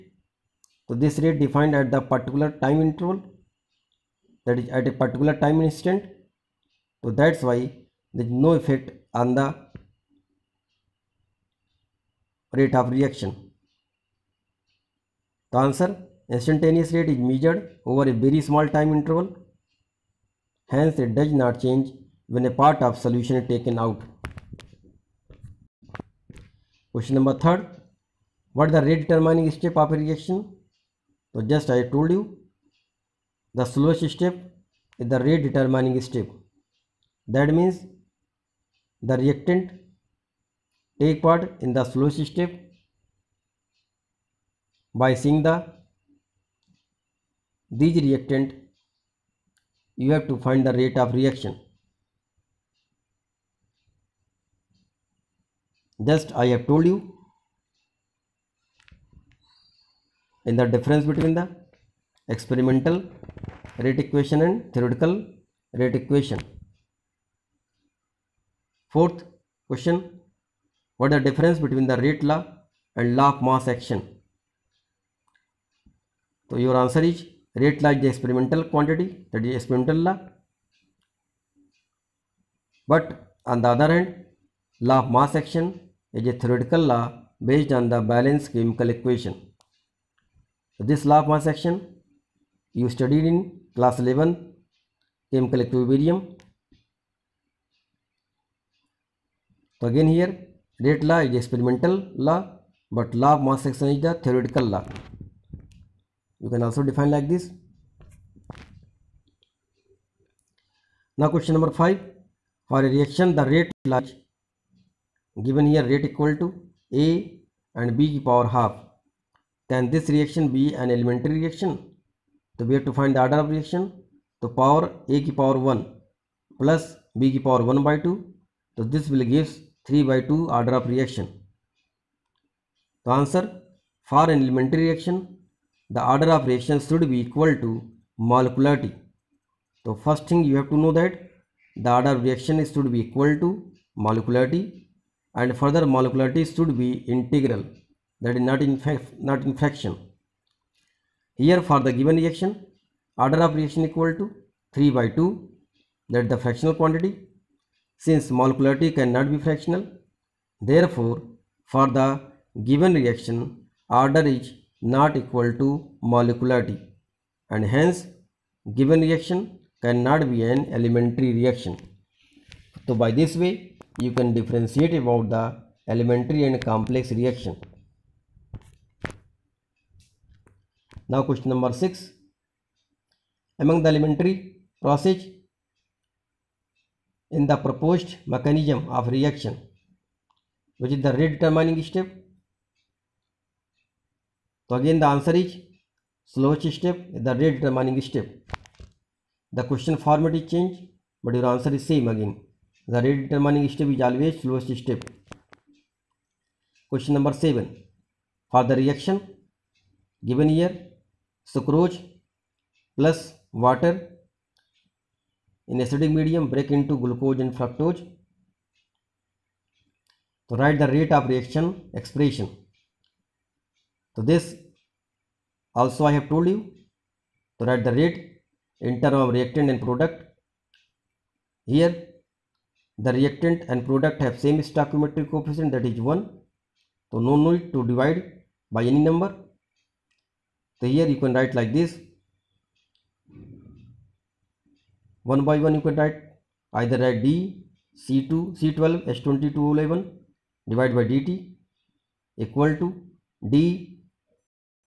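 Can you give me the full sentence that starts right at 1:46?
You can also define like this.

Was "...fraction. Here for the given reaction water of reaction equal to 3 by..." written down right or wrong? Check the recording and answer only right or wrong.
wrong.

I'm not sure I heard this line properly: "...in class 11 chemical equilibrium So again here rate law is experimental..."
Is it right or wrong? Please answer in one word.
right.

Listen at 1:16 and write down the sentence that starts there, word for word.
So your answer is rate law is the experimental quantity that is experimental law.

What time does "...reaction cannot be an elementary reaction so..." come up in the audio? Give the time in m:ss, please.
2:49.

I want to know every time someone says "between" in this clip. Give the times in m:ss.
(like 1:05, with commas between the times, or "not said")
1:01, 1:11.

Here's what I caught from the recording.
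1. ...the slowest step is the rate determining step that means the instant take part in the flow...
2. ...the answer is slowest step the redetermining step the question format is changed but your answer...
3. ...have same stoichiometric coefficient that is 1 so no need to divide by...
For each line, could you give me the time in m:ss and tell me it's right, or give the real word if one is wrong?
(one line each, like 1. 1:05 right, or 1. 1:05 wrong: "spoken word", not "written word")
1. 0:33 wrong: "reactant", not "instant"
2. 3:15 right
3. 3:54 right.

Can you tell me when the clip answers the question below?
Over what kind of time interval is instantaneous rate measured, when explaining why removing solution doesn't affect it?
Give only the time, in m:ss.
0:18.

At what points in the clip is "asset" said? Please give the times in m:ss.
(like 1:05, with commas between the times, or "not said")
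not said.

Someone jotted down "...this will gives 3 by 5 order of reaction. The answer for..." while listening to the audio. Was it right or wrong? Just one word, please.
wrong.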